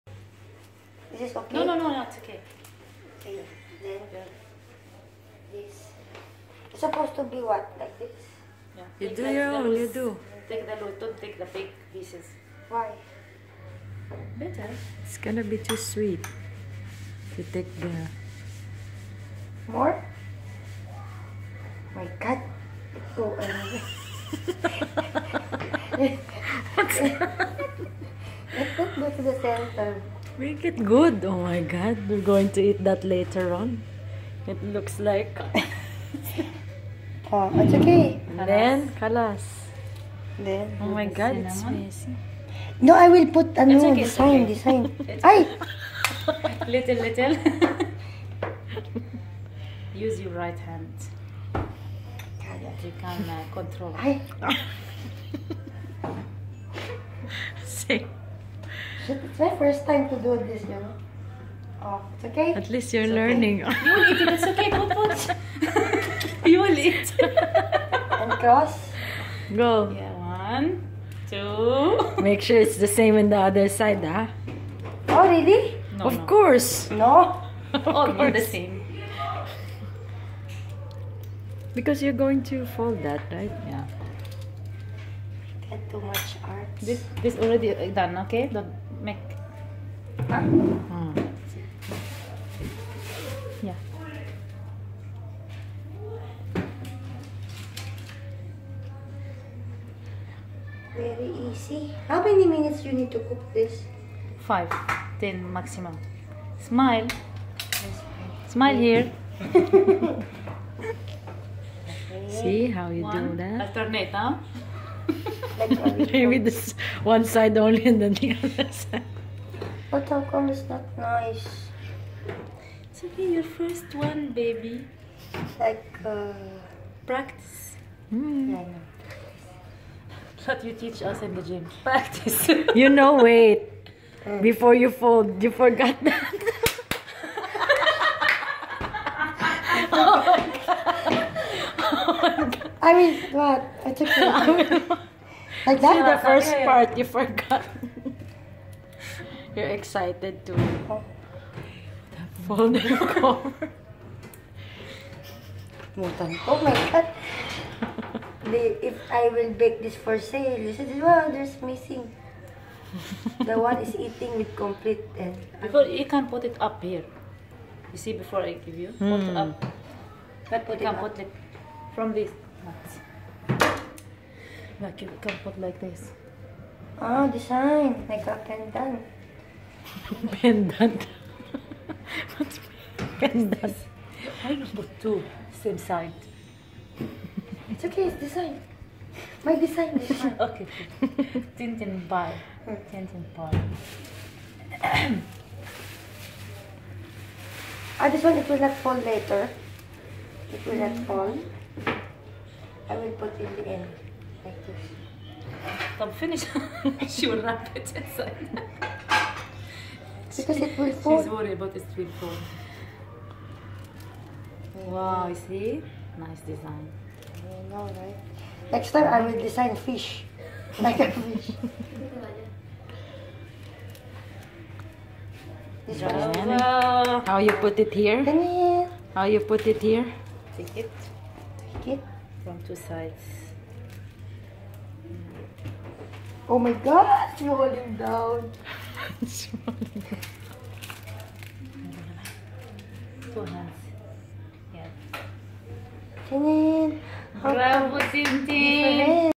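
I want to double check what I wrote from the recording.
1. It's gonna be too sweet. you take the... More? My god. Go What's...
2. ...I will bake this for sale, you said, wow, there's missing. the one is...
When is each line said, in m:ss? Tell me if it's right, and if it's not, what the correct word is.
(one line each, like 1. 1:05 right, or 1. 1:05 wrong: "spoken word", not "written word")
1. 0:15 right
2. 2:39 right.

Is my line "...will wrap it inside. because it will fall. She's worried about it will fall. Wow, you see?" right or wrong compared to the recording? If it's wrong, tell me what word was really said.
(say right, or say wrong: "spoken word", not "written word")
right.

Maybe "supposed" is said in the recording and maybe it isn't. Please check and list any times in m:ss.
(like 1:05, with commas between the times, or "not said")
0:06.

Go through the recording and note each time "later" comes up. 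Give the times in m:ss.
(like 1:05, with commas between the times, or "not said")
0:33, 3:18.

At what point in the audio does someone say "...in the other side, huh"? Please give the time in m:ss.
1:13.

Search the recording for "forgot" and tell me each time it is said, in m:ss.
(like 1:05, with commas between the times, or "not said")
2:15, 2:27.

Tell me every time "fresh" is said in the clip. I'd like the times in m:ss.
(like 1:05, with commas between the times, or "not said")
not said.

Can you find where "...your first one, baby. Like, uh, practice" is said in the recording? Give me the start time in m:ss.
2:03.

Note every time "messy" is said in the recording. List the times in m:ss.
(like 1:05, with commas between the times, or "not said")
0:41.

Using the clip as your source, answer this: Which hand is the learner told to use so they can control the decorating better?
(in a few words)
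Right hand.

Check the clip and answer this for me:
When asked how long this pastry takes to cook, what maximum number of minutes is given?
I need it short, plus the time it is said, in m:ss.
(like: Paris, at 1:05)
10, at 1:45.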